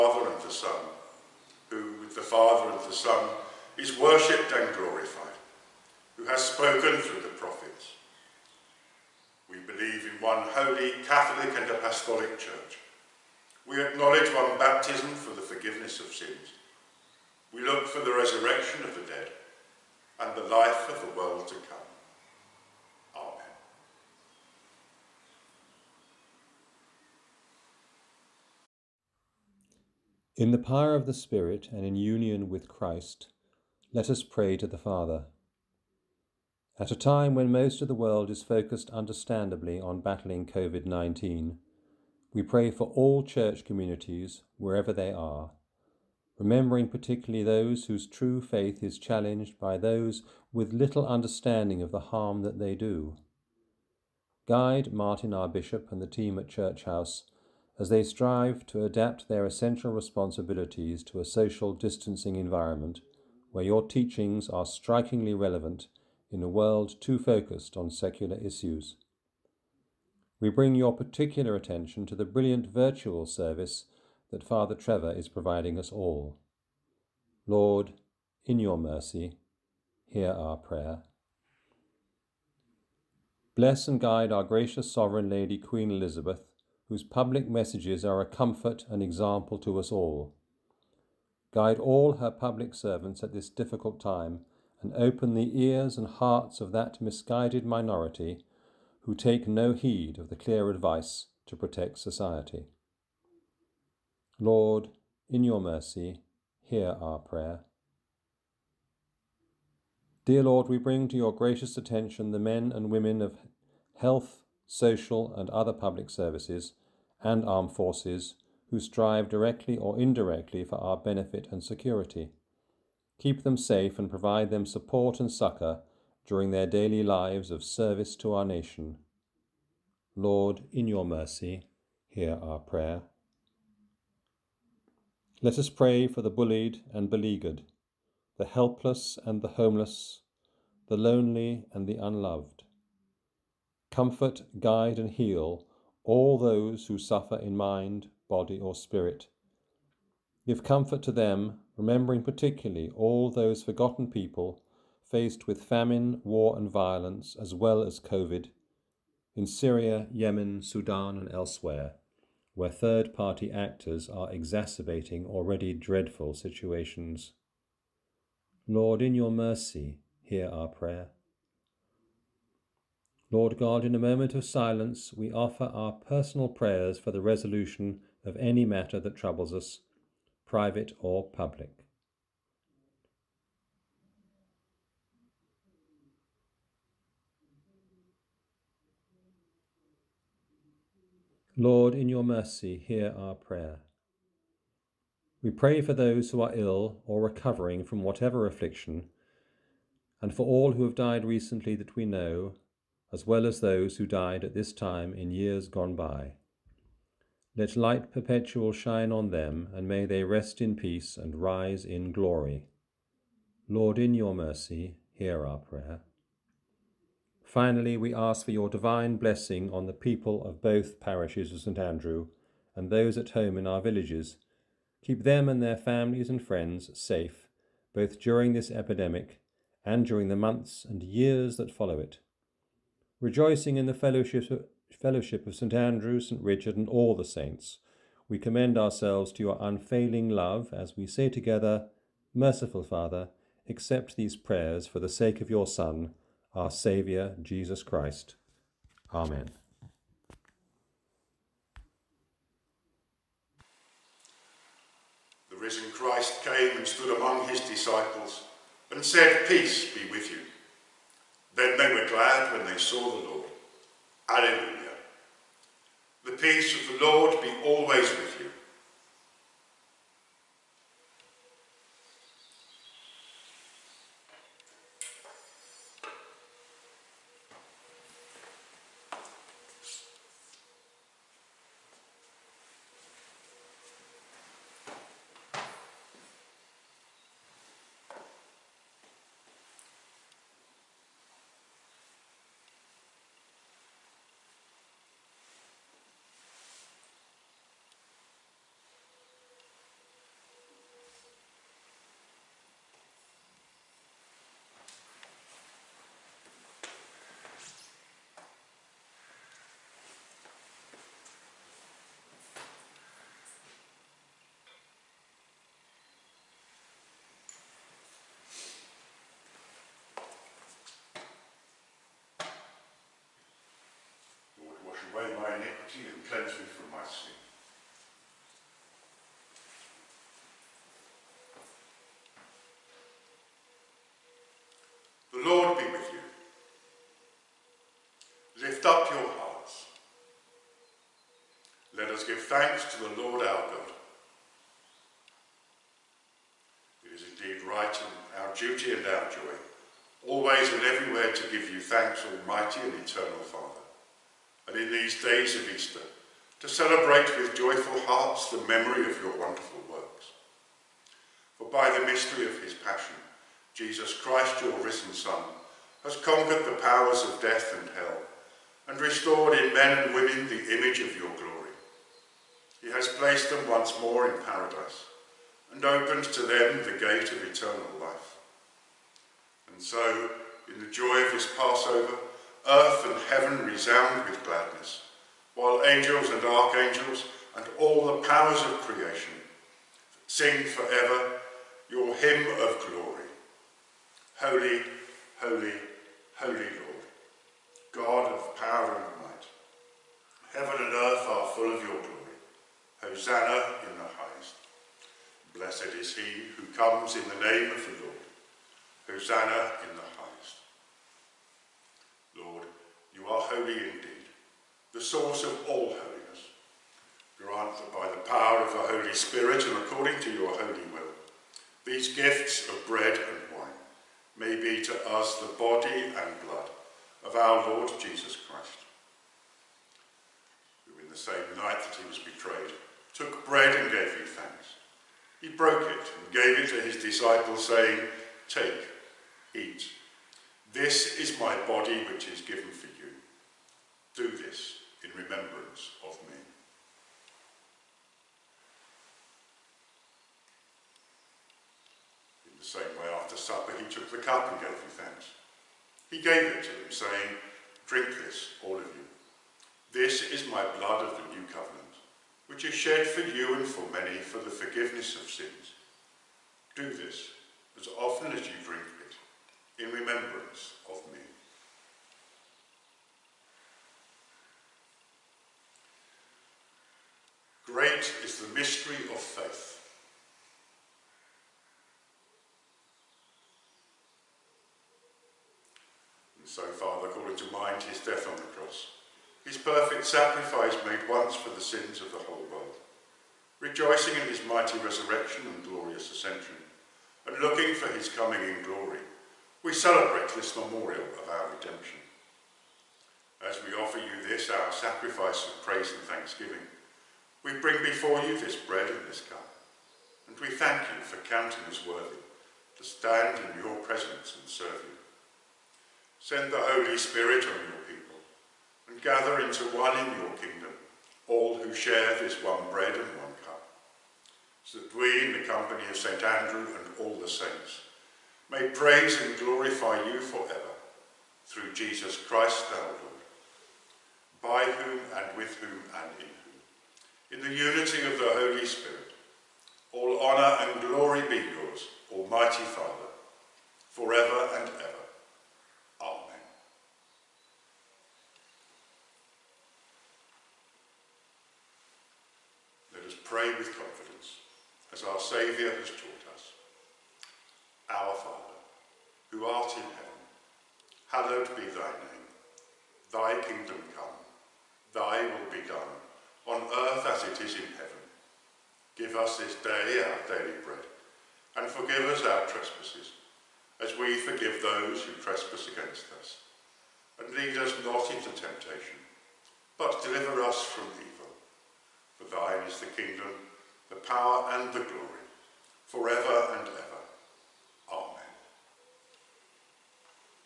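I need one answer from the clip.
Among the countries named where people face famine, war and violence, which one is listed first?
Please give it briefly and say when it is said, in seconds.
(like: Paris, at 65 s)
Syria, at 159 s.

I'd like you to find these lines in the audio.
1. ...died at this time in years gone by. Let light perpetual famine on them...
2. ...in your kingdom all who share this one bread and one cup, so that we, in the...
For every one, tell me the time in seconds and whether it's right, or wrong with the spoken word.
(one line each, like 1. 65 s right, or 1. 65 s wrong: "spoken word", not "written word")
1. 204 s wrong: "shine", not "famine"
2. 519 s right.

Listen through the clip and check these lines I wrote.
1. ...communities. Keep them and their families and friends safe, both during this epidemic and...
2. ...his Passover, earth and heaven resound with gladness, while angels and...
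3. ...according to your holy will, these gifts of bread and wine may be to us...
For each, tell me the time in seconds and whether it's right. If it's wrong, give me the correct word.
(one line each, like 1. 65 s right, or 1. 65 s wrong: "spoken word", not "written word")
1. 223 s wrong: "villages", not "communities"
2. 381 s right
3. 419 s right.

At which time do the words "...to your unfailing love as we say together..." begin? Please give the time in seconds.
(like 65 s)
239 s.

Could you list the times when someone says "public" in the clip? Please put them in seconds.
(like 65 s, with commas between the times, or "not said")
87 s, 92 s, 115 s, 181 s.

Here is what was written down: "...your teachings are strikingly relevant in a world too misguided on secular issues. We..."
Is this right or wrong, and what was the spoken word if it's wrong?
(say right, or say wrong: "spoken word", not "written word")
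wrong: "focused", not "misguided".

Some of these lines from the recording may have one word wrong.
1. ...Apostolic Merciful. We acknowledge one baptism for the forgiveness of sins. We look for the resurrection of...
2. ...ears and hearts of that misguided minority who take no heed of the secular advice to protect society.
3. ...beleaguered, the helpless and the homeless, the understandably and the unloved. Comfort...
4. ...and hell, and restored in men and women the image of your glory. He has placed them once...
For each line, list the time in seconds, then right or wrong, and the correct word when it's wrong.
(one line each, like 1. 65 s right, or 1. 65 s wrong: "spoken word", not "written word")
1. 11 s wrong: "Church", not "Merciful"
2. 95 s wrong: "clear", not "secular"
3. 137 s wrong: "lonely", not "understandably"
4. 367 s right.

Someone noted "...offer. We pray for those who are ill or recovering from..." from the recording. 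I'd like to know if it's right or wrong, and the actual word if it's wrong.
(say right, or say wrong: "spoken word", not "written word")
wrong: "prayer", not "offer".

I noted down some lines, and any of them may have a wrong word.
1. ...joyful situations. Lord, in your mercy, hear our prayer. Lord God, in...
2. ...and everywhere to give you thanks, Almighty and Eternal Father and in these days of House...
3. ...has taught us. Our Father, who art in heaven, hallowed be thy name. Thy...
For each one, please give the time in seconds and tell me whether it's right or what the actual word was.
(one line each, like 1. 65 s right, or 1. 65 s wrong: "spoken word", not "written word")
1. 165 s wrong: "dreadful", not "joyful"
2. 350 s wrong: "Easter", not "House"
3. 555 s right.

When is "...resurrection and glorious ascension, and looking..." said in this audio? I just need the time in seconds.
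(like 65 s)
494 s.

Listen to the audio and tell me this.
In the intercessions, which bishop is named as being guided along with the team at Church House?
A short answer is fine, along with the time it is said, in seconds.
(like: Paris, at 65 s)
Martin, at 54 s.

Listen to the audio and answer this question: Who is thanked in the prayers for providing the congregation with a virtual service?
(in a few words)
Father Trevor.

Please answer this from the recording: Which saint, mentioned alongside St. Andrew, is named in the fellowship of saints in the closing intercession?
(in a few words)
St. Richard.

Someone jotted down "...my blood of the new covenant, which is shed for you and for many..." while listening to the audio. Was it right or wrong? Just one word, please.
right.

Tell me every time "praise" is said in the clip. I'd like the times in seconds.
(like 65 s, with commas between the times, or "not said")
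505 s, 528 s.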